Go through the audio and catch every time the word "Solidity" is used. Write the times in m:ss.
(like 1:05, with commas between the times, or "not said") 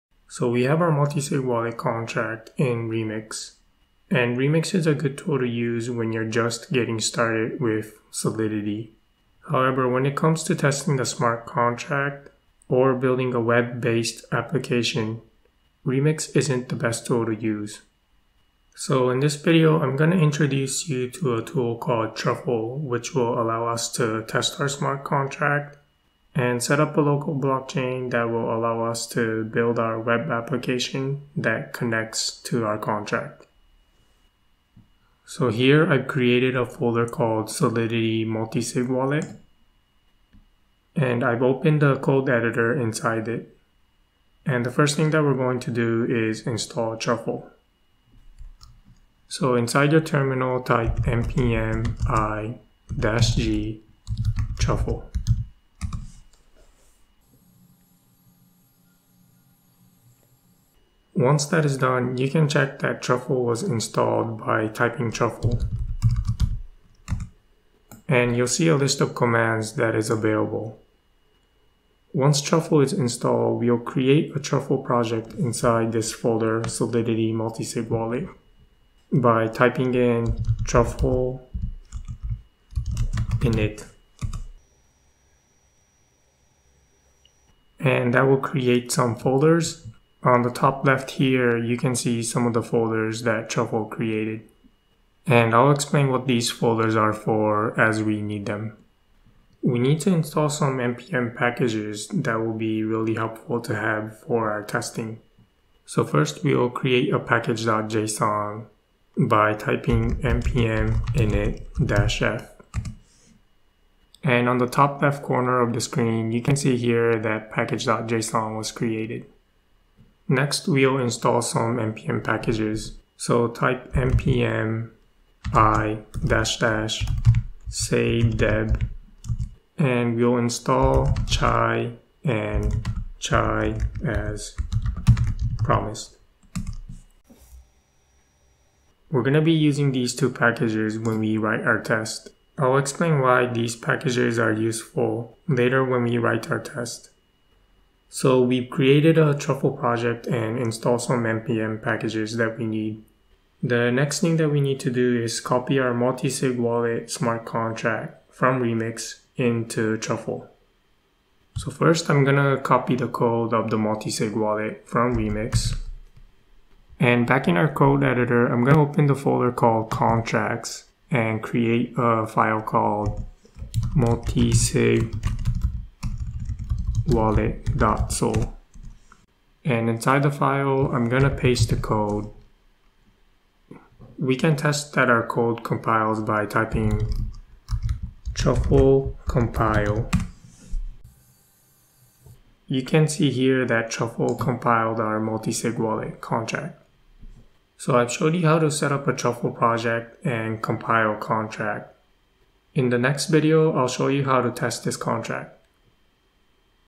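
0:08, 0:37, 1:16.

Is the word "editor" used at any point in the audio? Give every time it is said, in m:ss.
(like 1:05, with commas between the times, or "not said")
0:42, 2:48.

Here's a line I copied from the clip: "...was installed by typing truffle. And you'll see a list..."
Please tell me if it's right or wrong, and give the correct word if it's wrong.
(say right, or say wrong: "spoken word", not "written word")
right.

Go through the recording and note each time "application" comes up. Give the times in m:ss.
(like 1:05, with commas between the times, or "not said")
0:14, 0:30.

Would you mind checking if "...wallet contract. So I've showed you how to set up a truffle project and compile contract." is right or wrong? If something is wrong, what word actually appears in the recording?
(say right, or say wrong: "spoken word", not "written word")
right.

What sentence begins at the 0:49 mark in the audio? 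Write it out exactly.
So inside your terminal type npm i-g truffle.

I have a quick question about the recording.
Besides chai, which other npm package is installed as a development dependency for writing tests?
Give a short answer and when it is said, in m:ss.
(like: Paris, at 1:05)
chai as promised, at 2:13.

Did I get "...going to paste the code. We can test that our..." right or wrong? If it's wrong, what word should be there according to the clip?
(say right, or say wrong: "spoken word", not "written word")
right.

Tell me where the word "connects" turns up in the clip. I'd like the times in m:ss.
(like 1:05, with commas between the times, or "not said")
0:31.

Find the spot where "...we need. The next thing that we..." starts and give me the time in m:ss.
2:32.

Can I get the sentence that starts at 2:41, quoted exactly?
So first I'm gonna copy the code of the multi-sig wallet from Remix.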